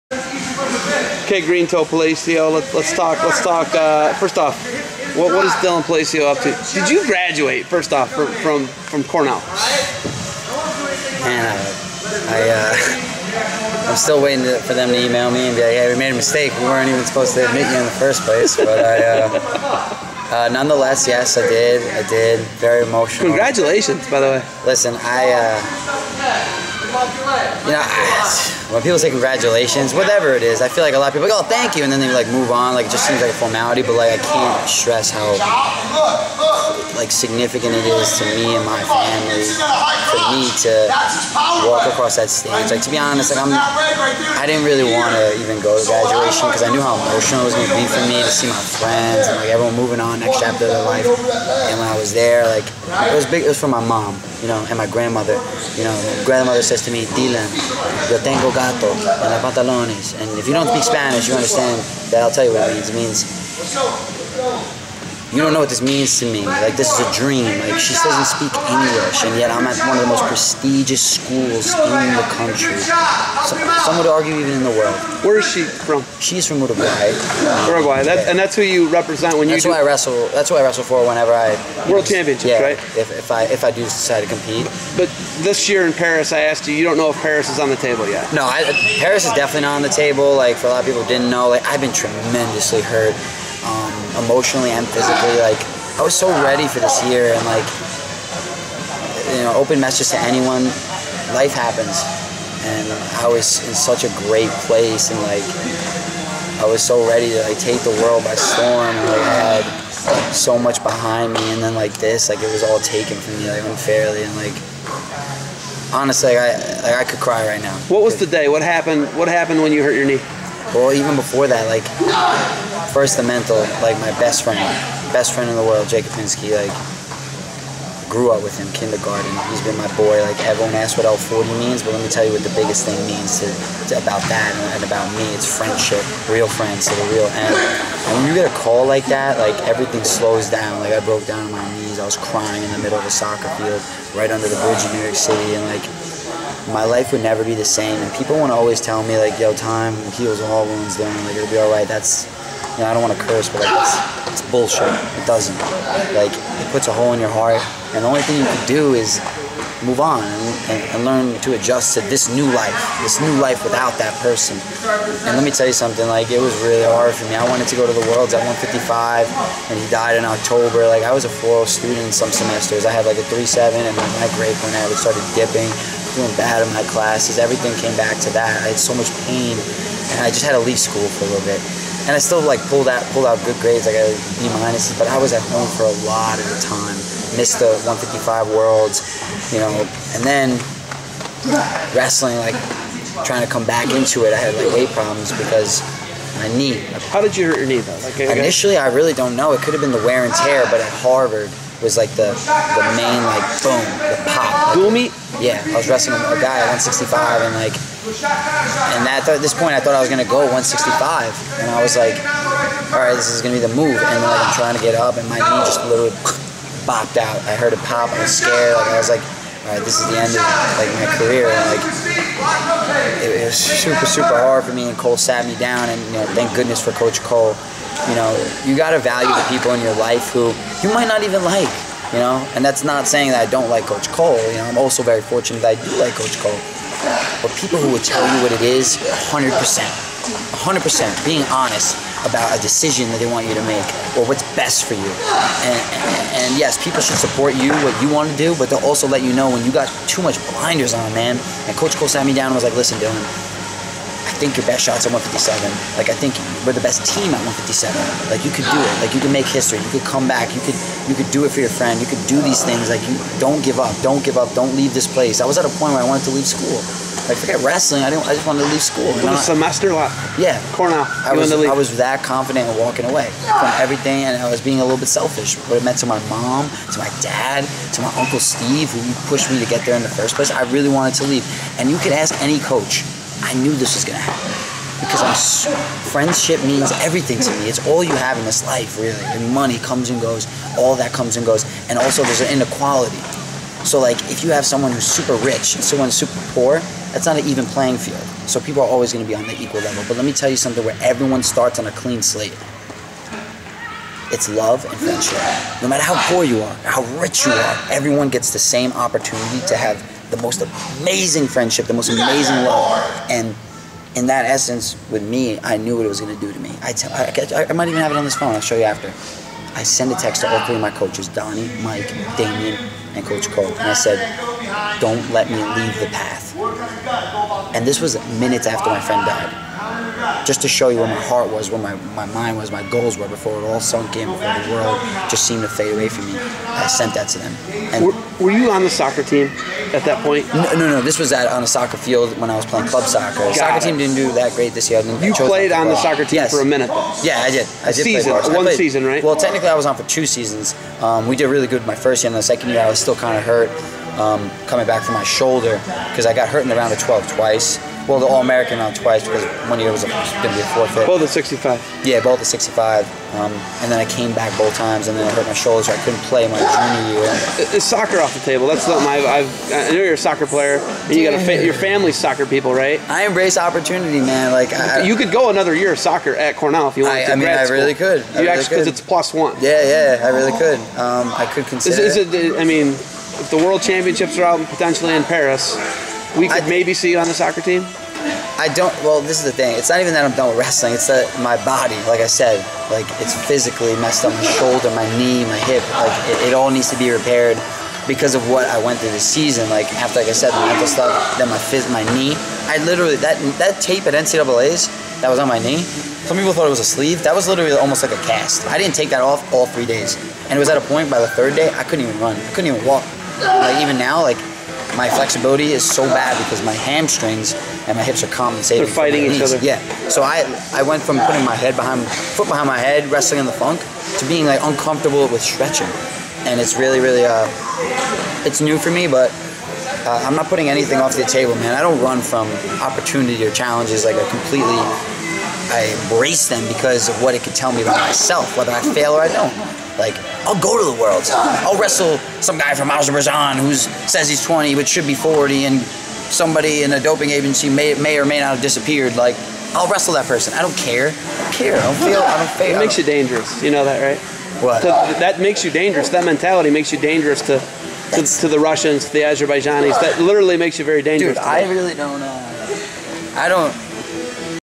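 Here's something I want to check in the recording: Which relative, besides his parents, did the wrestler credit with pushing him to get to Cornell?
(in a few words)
Uncle Steve.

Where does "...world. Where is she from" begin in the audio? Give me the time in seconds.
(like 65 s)
74 s.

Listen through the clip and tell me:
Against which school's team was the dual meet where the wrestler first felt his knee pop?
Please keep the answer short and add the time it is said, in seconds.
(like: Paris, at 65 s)
Harvard, at 200 s.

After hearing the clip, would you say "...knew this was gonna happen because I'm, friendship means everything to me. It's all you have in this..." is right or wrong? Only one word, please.
right.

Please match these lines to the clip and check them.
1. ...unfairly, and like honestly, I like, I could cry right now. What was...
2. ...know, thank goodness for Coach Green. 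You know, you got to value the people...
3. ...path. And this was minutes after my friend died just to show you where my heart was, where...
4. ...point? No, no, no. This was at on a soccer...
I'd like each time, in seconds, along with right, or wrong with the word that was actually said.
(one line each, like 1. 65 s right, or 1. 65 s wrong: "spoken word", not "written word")
1. 113 s right
2. 226 s wrong: "Koll", not "Green"
3. 326 s right
4. 340 s right.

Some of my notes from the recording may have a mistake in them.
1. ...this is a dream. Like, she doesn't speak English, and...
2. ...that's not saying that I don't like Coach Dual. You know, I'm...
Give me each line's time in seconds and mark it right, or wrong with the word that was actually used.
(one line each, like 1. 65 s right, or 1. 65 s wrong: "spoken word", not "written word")
1. 66 s right
2. 232 s wrong: "Koll", not "Dual".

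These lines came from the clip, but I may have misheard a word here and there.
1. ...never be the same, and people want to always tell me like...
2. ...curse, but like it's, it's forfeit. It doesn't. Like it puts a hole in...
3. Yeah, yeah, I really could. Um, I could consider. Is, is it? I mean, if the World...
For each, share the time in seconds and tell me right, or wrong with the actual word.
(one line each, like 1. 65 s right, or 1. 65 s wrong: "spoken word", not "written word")
1. 147 s right
2. 153 s wrong: "bullshit", not "forfeit"
3. 379 s right.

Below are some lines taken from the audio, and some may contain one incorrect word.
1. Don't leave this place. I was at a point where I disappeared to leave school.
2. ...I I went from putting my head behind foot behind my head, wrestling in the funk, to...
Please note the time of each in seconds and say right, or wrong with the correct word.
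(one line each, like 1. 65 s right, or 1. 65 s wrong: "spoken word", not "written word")
1. 264 s wrong: "wanted", not "disappeared"
2. 420 s right.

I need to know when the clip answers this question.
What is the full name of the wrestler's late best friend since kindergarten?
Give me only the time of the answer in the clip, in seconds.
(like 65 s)
125 s.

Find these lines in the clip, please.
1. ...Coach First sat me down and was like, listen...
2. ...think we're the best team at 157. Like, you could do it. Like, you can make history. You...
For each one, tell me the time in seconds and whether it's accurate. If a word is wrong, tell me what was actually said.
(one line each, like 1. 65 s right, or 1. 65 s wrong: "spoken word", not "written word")
1. 251 s wrong: "Koll", not "First"
2. 256 s right.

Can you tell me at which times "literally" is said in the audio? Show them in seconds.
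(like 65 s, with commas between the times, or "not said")
215 s, 402 s, 407 s, 460 s.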